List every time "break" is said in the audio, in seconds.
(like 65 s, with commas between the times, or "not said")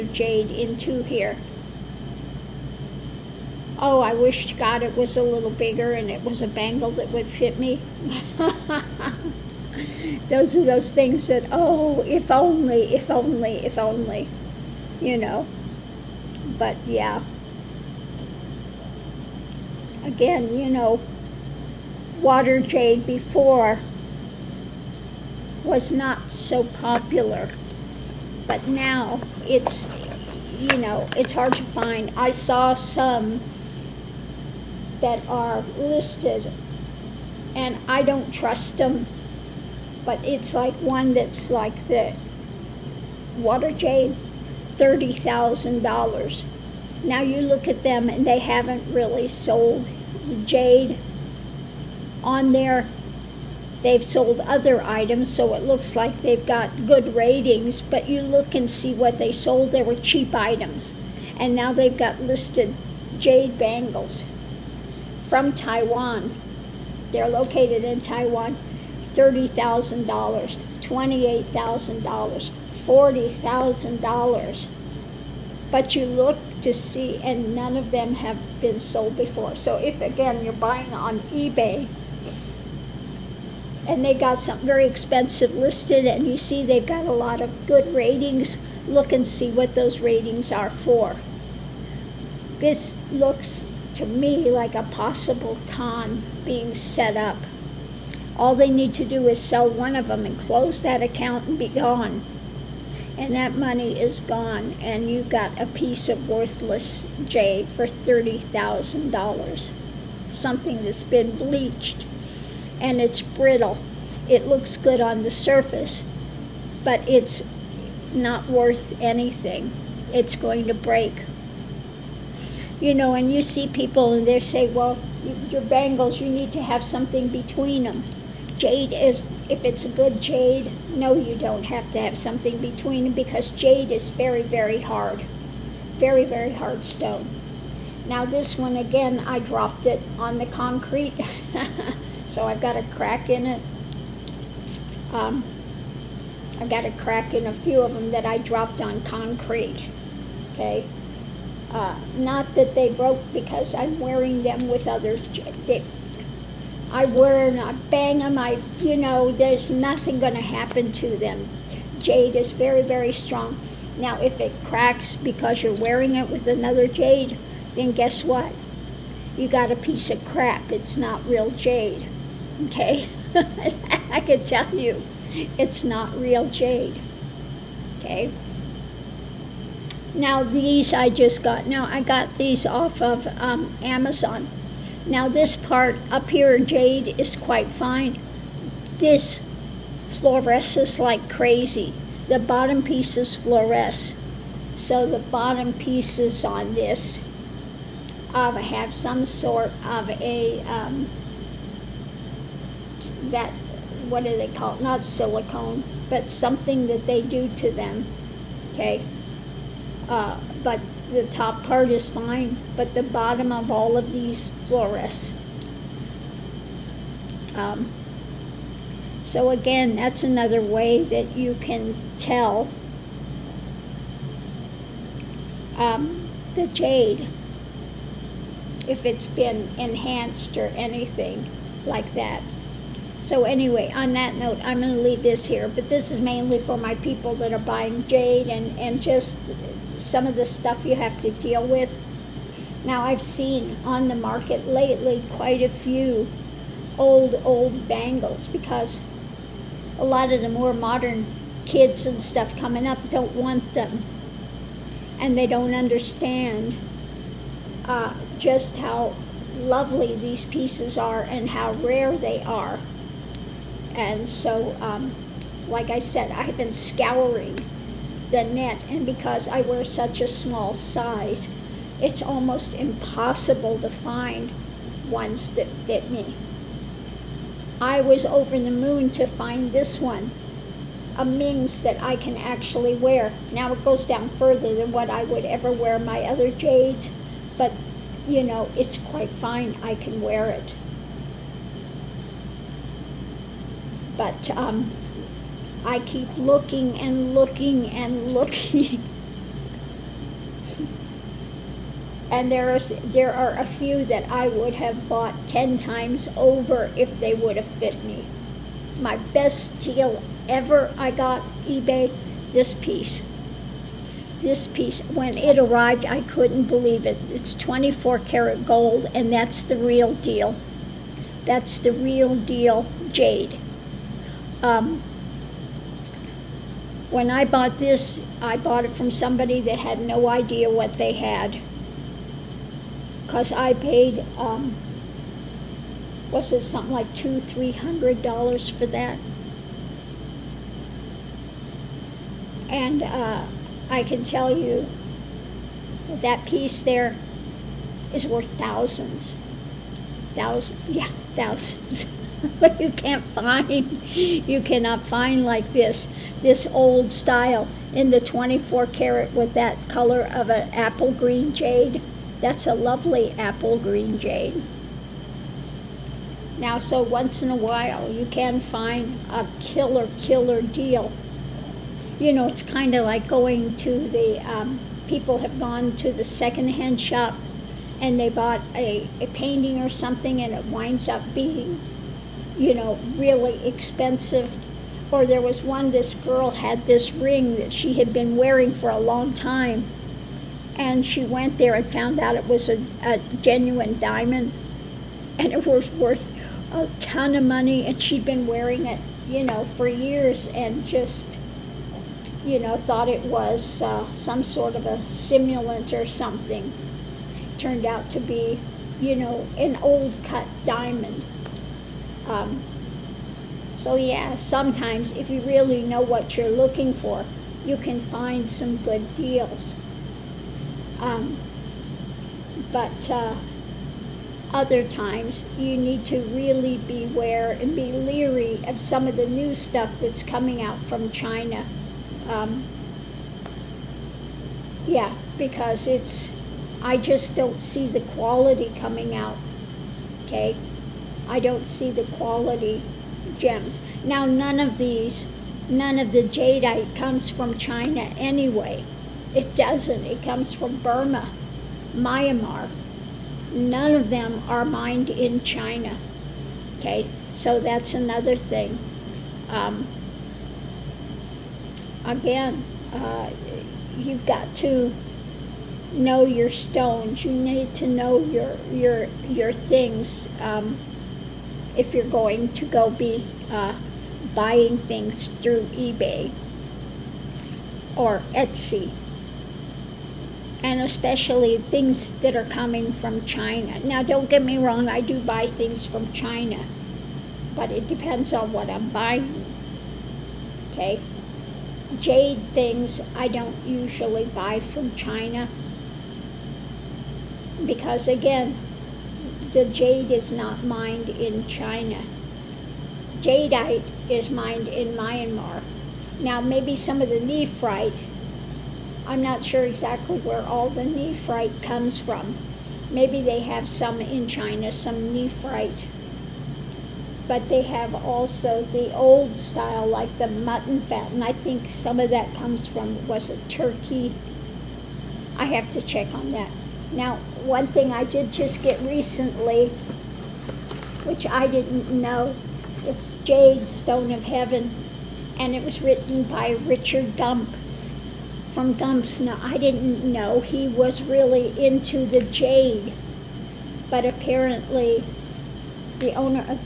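120 s.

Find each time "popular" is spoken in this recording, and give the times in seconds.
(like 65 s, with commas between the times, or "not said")
26 s.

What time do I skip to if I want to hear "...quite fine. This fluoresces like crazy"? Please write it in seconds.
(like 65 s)
187 s.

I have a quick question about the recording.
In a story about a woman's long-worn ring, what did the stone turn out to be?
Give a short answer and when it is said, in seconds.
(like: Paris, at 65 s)
A genuine diamond, at 393 s.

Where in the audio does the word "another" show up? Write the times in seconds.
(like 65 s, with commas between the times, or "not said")
166 s, 220 s, 457 s.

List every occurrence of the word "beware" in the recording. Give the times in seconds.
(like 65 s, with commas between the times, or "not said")
426 s.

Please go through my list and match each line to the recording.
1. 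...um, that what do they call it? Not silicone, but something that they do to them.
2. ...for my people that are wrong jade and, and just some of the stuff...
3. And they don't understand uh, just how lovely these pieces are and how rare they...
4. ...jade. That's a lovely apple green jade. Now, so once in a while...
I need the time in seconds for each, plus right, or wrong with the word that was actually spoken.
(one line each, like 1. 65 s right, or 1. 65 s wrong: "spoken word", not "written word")
1. 200 s right
2. 236 s wrong: "buying", not "wrong"
3. 255 s right
4. 361 s right.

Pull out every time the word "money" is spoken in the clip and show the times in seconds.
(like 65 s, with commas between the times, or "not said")
103 s, 397 s.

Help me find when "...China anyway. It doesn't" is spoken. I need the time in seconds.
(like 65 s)
447 s.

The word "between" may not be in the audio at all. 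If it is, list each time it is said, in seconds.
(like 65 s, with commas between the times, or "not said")
127 s, 132 s.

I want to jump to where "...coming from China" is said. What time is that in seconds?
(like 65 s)
482 s.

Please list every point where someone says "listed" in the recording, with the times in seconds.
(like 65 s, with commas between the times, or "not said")
35 s, 62 s, 85 s.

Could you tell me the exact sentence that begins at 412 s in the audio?
Um, so yeah, sometimes if you really know what you're looking for, you can find some good deals.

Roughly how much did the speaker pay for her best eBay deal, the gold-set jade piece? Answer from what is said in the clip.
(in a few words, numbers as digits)
$200-300.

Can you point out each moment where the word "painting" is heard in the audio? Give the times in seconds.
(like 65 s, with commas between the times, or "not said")
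379 s.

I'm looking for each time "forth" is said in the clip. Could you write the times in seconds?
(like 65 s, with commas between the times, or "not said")
not said.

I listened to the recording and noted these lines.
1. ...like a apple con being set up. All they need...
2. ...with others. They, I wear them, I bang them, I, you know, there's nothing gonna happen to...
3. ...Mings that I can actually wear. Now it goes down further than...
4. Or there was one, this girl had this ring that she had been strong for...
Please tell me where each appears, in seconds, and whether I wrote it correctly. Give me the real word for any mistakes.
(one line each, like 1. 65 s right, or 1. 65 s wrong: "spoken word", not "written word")
1. 94 s wrong: "possible", not "apple"
2. 154 s right
3. 281 s right
4. 385 s wrong: "wearing", not "strong".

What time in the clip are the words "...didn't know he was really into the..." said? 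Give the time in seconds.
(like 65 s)
539 s.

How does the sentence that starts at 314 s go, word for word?
This piece, when it arrived, I couldn't believe it.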